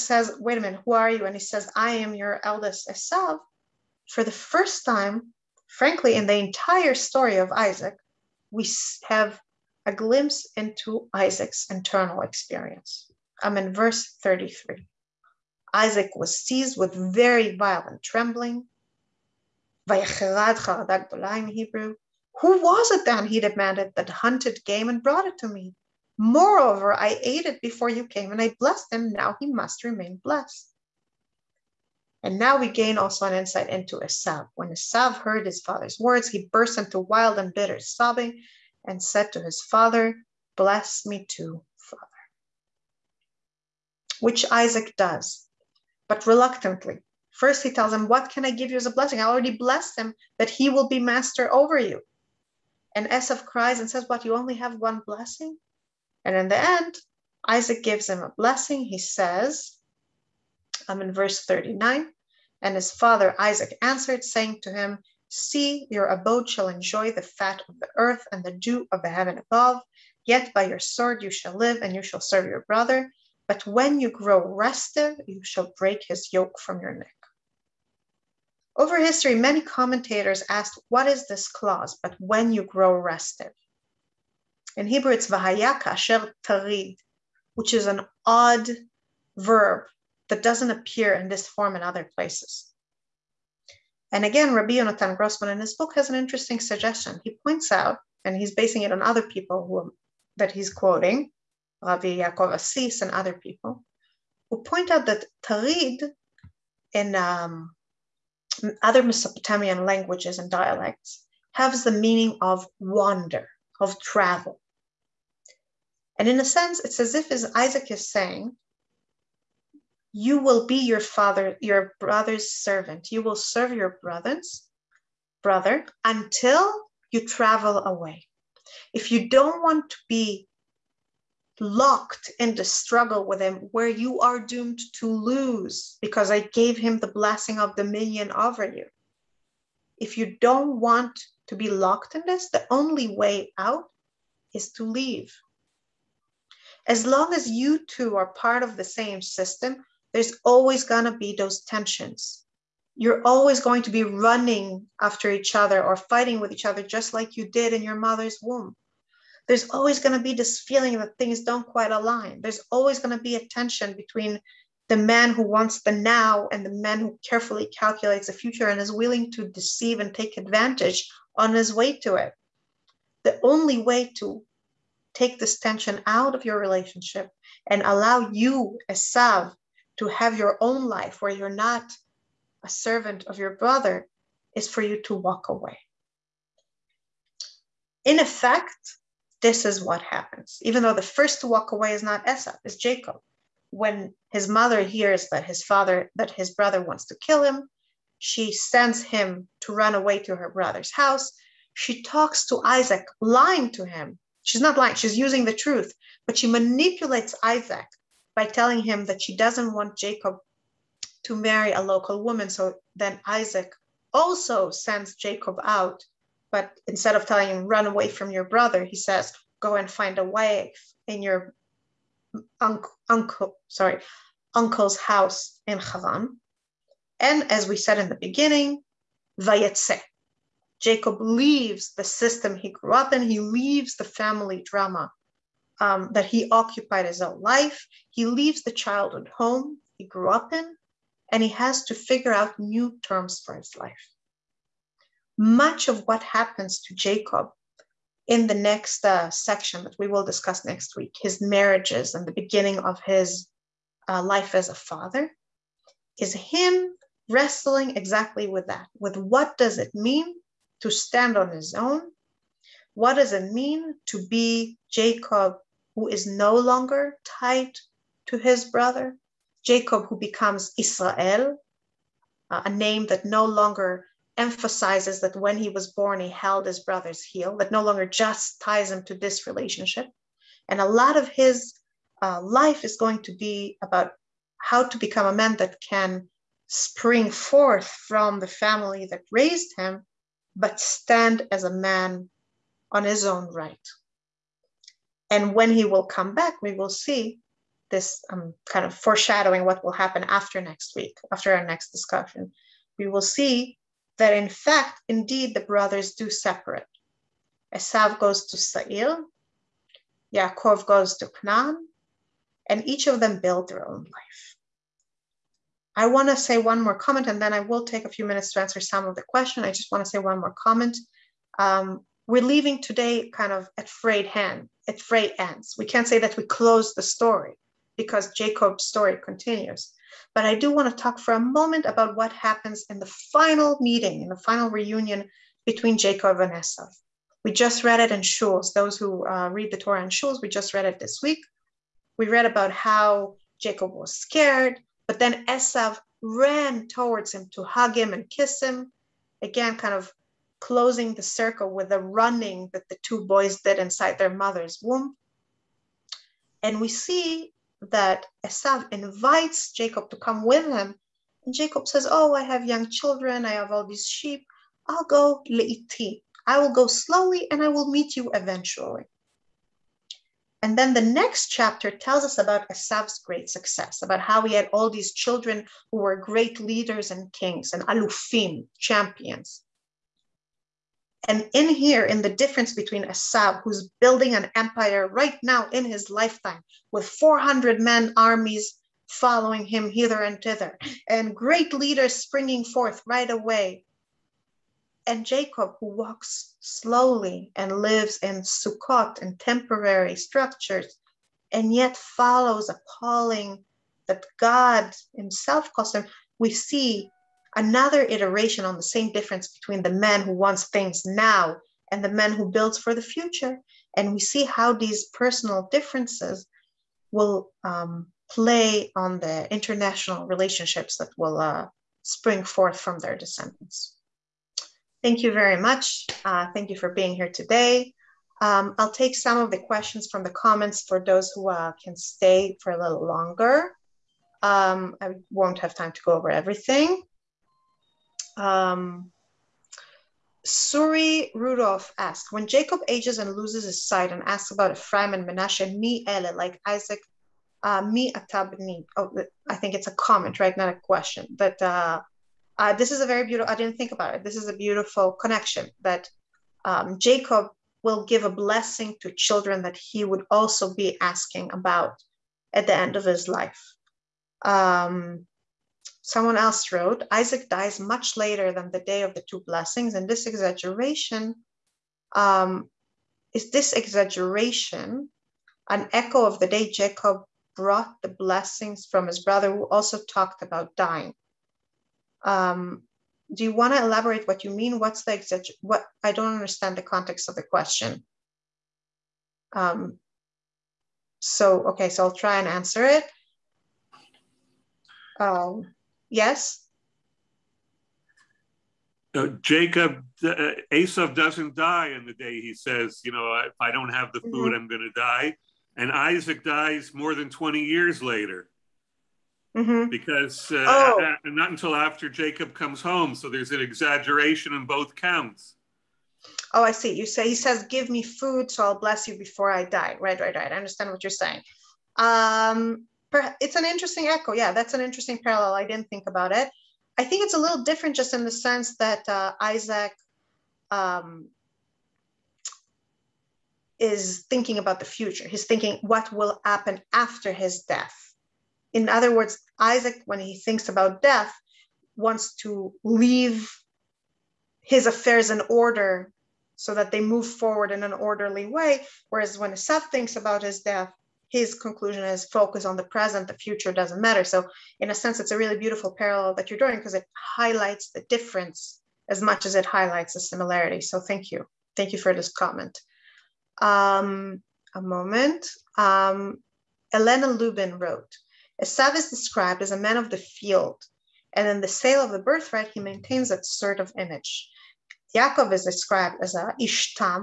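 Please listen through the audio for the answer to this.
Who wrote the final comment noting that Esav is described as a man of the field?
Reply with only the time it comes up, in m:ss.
9:26.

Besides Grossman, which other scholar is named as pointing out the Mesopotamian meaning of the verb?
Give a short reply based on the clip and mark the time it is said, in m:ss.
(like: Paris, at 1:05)
Rabbi Yaakov Assis, at 1:41.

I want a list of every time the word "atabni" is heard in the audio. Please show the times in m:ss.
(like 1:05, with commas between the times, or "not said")
7:28.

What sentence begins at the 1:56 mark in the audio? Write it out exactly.
And in a sense, it's as if as Isaac is saying, you will be your father, your brother's servant.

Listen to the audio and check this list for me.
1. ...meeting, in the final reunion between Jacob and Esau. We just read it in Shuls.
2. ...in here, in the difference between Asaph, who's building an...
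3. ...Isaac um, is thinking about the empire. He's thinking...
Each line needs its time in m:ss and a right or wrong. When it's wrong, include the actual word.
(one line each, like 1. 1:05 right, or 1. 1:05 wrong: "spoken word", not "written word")
1. 5:33 right
2. 6:21 right
3. 8:49 wrong: "future", not "empire".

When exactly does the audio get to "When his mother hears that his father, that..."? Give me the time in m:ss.
3:13.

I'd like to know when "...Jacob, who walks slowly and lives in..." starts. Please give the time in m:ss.
6:35.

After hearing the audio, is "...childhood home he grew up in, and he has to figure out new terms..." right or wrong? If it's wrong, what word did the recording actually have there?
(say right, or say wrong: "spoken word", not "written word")
right.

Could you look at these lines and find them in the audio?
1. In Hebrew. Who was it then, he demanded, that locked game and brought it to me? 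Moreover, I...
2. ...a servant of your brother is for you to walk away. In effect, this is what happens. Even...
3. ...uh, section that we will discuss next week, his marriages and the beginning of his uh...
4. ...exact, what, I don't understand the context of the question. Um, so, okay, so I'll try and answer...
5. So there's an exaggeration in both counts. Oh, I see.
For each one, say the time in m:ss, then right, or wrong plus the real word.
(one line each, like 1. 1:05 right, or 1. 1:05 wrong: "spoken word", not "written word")
1. 0:19 wrong: "hunted", not "locked"
2. 3:02 right
3. 4:09 right
4. 8:05 right
5. 8:33 right.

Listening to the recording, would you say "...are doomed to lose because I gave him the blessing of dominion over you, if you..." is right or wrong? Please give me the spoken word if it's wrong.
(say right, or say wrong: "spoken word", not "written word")
right.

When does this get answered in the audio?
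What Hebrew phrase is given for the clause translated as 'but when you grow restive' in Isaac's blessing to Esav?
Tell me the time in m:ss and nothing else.
1:25.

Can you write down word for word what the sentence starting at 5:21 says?
Um, we're leaving today kind of at frayed hand, at frayed ends.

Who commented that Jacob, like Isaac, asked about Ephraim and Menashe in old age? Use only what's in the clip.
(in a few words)
Suri Rudolph.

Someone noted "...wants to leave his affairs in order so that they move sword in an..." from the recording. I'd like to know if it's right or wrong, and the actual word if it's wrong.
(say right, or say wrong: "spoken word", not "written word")
wrong: "forward", not "sword".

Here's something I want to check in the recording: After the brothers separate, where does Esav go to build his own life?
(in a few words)
Sa'ir.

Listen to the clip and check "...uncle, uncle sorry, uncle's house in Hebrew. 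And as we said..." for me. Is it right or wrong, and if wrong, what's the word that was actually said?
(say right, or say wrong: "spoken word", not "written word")
wrong: "Haran", not "Hebrew".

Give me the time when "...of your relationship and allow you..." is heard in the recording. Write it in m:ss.
2:56.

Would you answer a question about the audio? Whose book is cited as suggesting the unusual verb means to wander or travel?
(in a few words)
Rabbi Yonatan Grossman.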